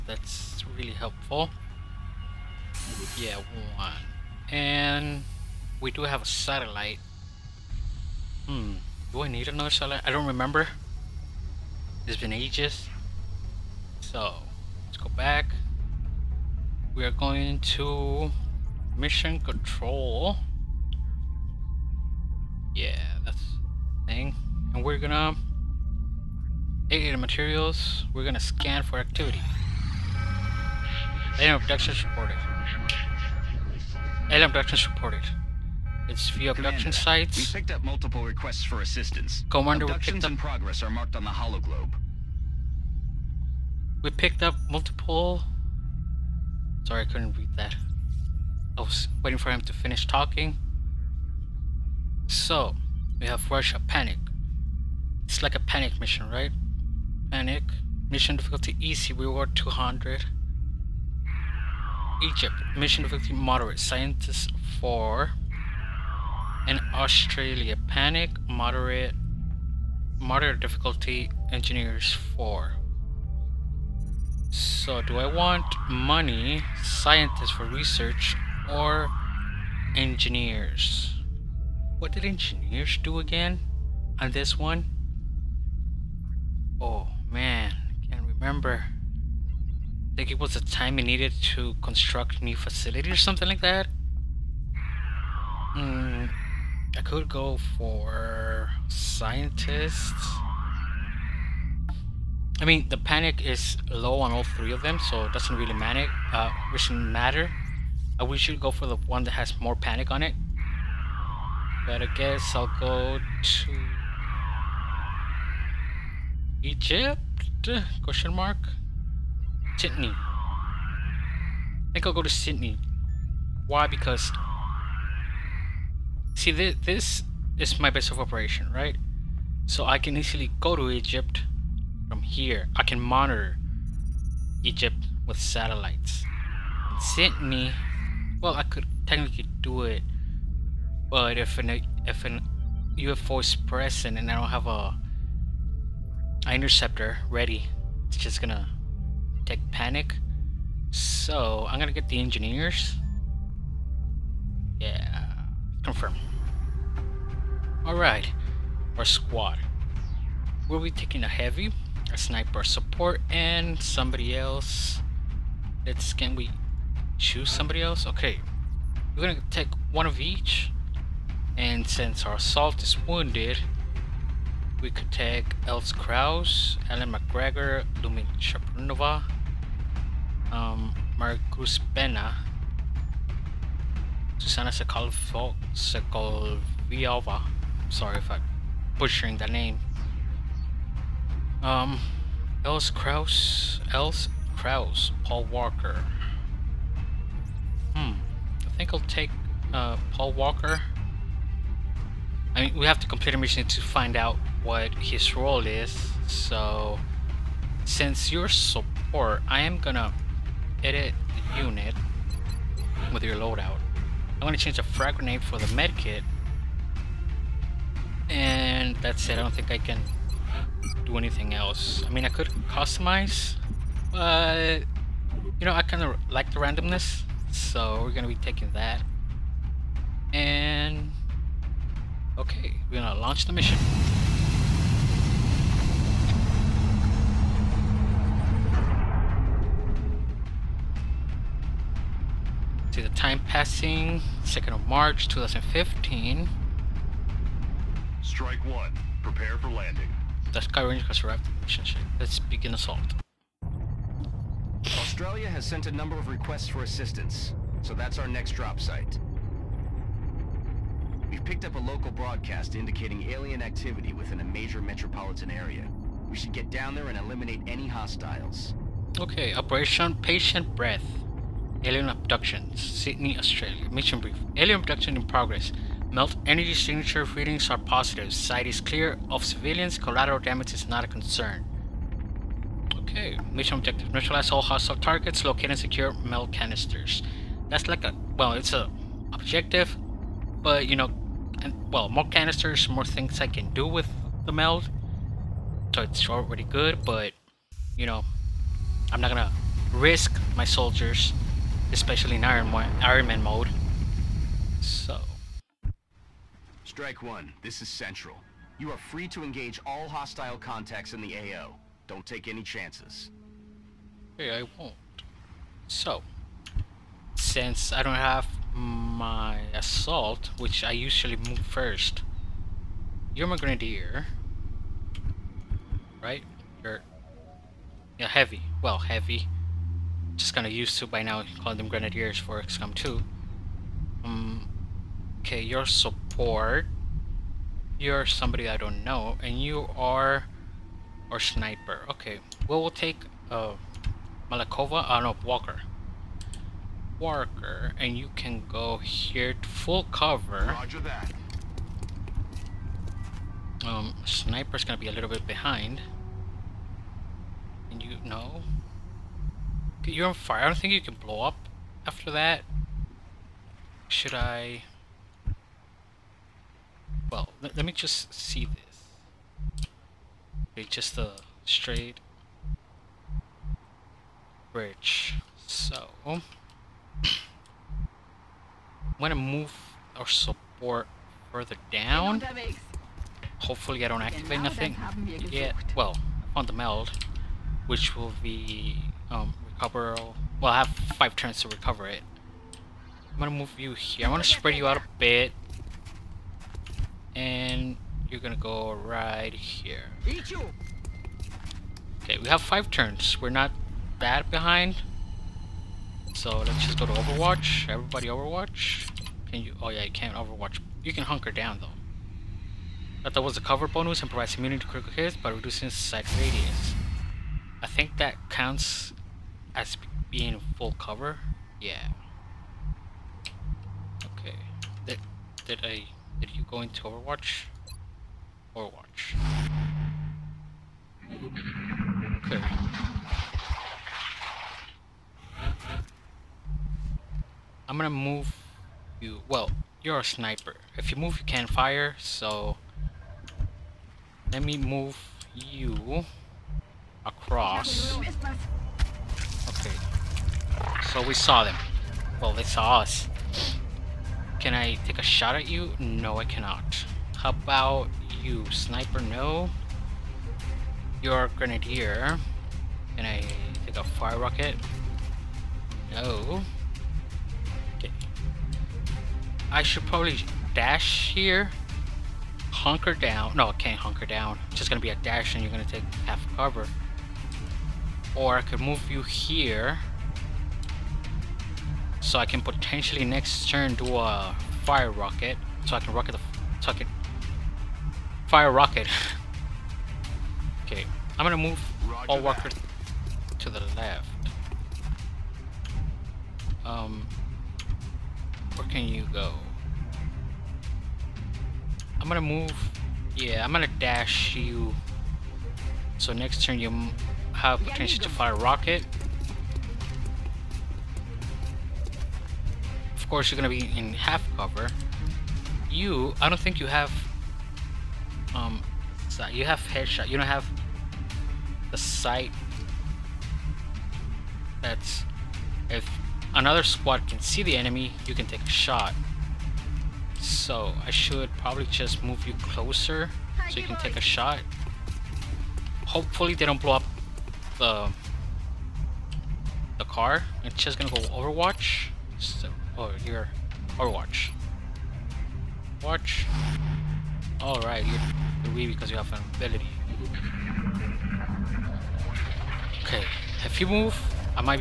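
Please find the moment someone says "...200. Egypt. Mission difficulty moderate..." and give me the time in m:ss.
0:59.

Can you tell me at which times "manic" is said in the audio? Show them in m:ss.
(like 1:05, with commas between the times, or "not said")
1:45.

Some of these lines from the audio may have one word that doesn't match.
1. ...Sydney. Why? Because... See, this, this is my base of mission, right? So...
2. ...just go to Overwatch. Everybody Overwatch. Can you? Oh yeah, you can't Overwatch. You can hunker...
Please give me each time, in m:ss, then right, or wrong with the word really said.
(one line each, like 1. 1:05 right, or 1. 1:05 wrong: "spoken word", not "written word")
1. 2:02 wrong: "operation", not "mission"
2. 6:46 right.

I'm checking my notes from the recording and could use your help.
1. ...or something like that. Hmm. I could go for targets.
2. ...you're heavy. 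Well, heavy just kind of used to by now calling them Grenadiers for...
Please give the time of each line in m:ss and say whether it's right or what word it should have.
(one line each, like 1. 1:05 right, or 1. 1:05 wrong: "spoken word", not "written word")
1. 1:33 wrong: "scientists", not "targets"
2. 5:28 right.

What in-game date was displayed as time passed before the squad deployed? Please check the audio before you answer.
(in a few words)
2nd of March 2015.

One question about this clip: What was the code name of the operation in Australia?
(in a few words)
Operation Patient Breath.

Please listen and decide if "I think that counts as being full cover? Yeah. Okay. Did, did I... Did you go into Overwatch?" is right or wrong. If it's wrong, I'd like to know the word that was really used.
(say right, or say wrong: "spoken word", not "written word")
right.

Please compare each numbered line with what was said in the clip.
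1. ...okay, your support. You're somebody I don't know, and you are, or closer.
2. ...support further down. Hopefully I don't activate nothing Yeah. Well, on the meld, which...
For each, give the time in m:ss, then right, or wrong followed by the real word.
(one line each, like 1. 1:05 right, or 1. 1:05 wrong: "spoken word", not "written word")
1. 5:35 wrong: "sniper", not "closer"
2. 6:20 right.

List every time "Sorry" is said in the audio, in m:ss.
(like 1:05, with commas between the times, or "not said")
0:46, 3:07.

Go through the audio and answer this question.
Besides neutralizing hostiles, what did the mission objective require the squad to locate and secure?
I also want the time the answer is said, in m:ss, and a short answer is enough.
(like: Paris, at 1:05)
meld canisters, at 4:46.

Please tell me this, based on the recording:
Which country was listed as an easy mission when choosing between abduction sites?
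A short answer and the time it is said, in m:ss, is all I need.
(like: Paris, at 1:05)
Russia, at 0:53.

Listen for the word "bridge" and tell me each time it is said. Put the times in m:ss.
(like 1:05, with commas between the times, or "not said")
6:14.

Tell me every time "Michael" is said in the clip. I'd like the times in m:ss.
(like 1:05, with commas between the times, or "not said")
not said.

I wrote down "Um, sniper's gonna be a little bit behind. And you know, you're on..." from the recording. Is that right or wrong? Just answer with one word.
right.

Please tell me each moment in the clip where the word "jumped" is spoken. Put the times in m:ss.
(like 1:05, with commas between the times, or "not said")
not said.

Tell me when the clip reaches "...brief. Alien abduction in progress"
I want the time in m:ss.
4:34.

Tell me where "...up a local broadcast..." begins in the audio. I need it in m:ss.
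4:21.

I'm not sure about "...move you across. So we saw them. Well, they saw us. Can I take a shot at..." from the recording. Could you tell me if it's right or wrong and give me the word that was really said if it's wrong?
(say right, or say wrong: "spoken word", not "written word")
right.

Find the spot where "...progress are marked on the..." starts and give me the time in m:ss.
0:40.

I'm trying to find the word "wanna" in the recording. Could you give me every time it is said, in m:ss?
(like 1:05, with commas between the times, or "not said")
6:34.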